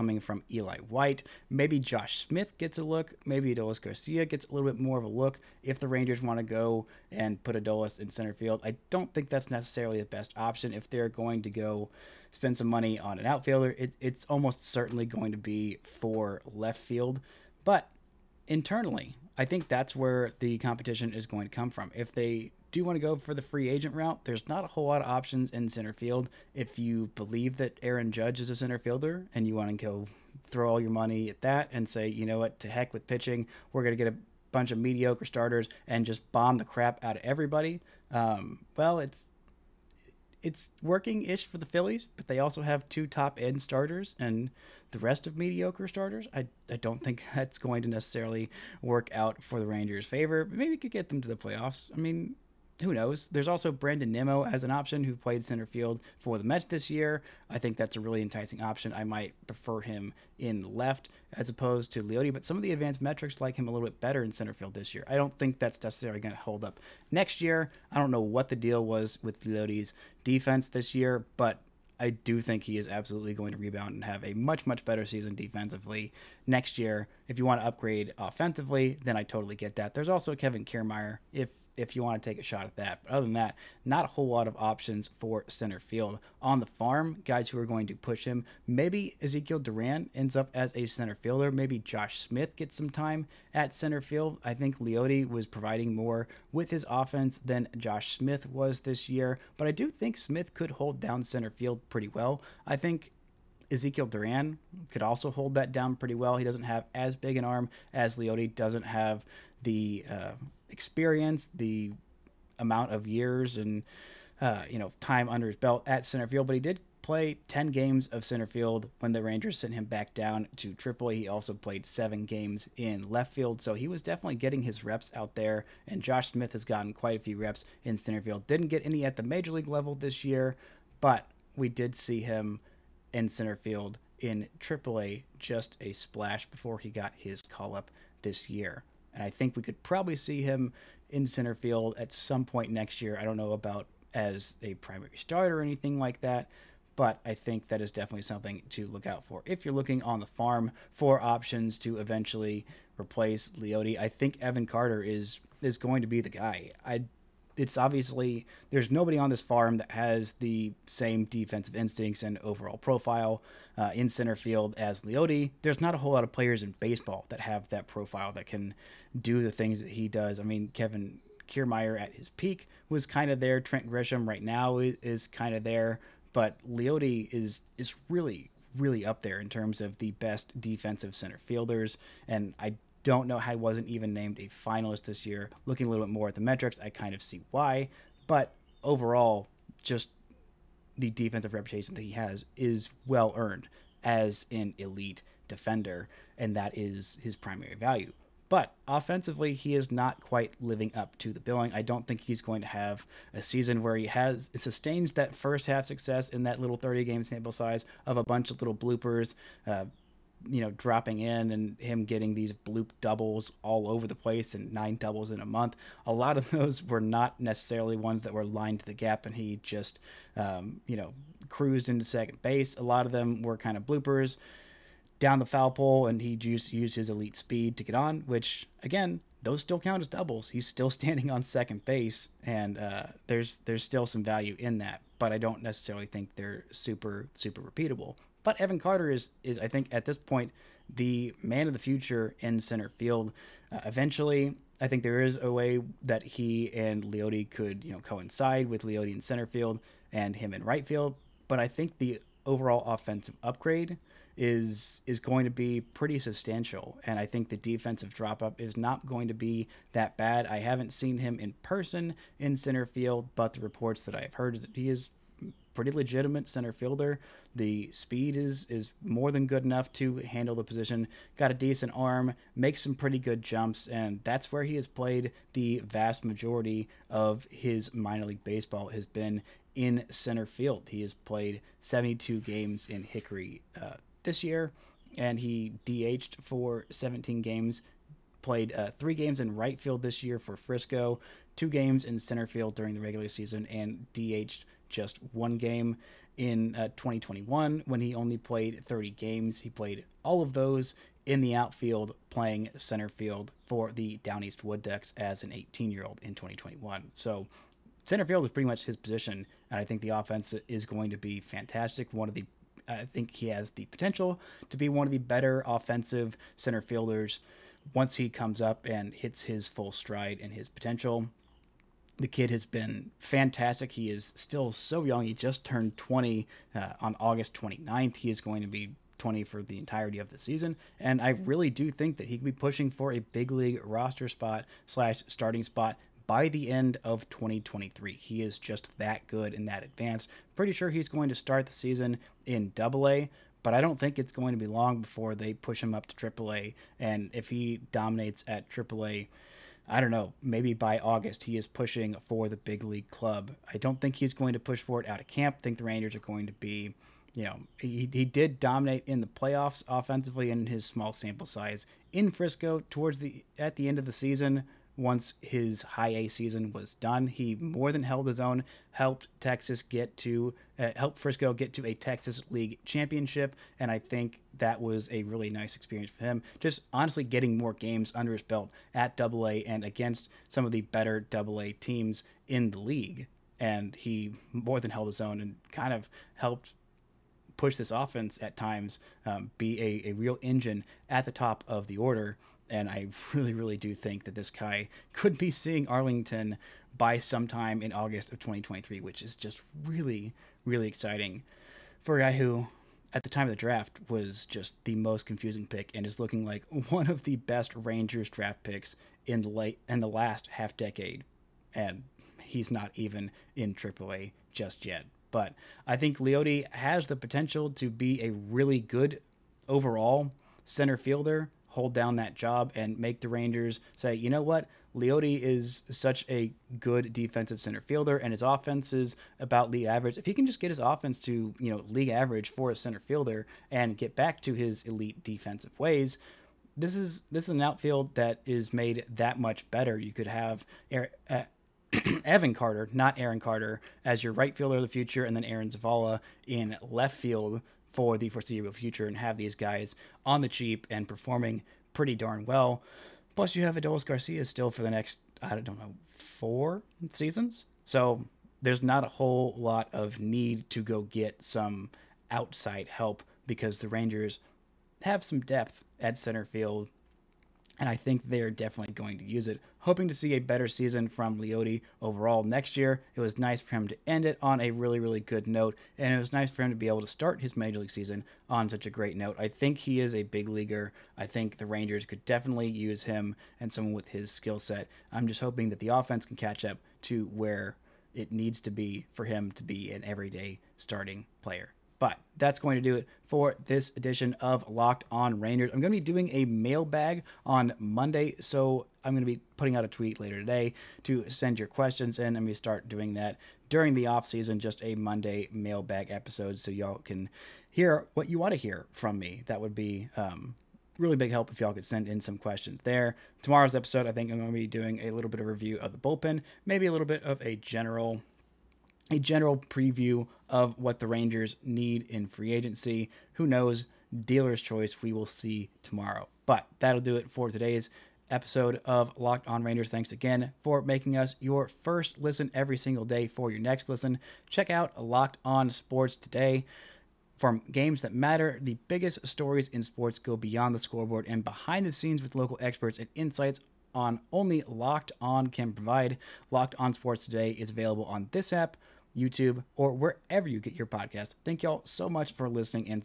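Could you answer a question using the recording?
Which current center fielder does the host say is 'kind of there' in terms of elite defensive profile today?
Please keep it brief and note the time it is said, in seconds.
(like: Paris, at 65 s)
Trent Grisham, at 173 s.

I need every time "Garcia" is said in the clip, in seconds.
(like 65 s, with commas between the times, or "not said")
3 s, 454 s.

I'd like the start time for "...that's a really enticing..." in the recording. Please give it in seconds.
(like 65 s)
57 s.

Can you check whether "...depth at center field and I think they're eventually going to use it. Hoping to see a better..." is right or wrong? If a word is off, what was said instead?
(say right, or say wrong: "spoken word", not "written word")
wrong: "definitely", not "eventually".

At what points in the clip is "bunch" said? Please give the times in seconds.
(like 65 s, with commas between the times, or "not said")
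34 s, 208 s.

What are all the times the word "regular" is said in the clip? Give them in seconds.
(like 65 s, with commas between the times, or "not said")
293 s.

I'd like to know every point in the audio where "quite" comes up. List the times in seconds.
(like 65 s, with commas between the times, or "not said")
126 s, 200 s.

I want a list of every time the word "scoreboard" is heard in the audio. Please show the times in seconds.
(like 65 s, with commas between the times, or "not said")
540 s.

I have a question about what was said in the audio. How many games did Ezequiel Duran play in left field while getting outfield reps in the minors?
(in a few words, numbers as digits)
7.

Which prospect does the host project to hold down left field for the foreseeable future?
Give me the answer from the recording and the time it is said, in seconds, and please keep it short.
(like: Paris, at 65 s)
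Aaron Zavala, at 445 s.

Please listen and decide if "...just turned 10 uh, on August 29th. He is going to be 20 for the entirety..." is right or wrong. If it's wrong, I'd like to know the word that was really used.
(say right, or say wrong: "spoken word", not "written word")
wrong: "20", not "10".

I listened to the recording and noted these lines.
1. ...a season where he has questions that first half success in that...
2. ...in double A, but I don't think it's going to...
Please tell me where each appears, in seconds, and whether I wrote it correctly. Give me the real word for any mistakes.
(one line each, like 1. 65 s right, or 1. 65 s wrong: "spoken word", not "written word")
1. 203 s wrong: "sustains", not "questions"
2. 342 s right.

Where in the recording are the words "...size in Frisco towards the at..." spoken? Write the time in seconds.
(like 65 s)
361 s.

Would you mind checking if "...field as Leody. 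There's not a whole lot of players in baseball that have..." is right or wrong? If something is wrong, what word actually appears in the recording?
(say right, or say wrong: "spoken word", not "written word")
right.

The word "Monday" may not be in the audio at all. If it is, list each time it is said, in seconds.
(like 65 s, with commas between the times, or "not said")
497 s, 504 s.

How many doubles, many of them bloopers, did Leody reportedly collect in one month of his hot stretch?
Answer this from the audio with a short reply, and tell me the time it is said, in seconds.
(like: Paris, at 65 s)
9, at 214 s.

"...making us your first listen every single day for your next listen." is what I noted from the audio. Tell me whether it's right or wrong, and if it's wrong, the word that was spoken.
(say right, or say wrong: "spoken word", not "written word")
right.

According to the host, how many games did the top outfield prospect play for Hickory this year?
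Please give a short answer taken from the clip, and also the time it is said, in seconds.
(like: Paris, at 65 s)
72, at 281 s.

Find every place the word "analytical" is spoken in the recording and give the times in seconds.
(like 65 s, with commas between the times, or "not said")
not said.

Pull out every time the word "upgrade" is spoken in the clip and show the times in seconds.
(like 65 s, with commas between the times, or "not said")
77 s, 253 s.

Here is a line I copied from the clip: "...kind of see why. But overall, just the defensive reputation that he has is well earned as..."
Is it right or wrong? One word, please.
right.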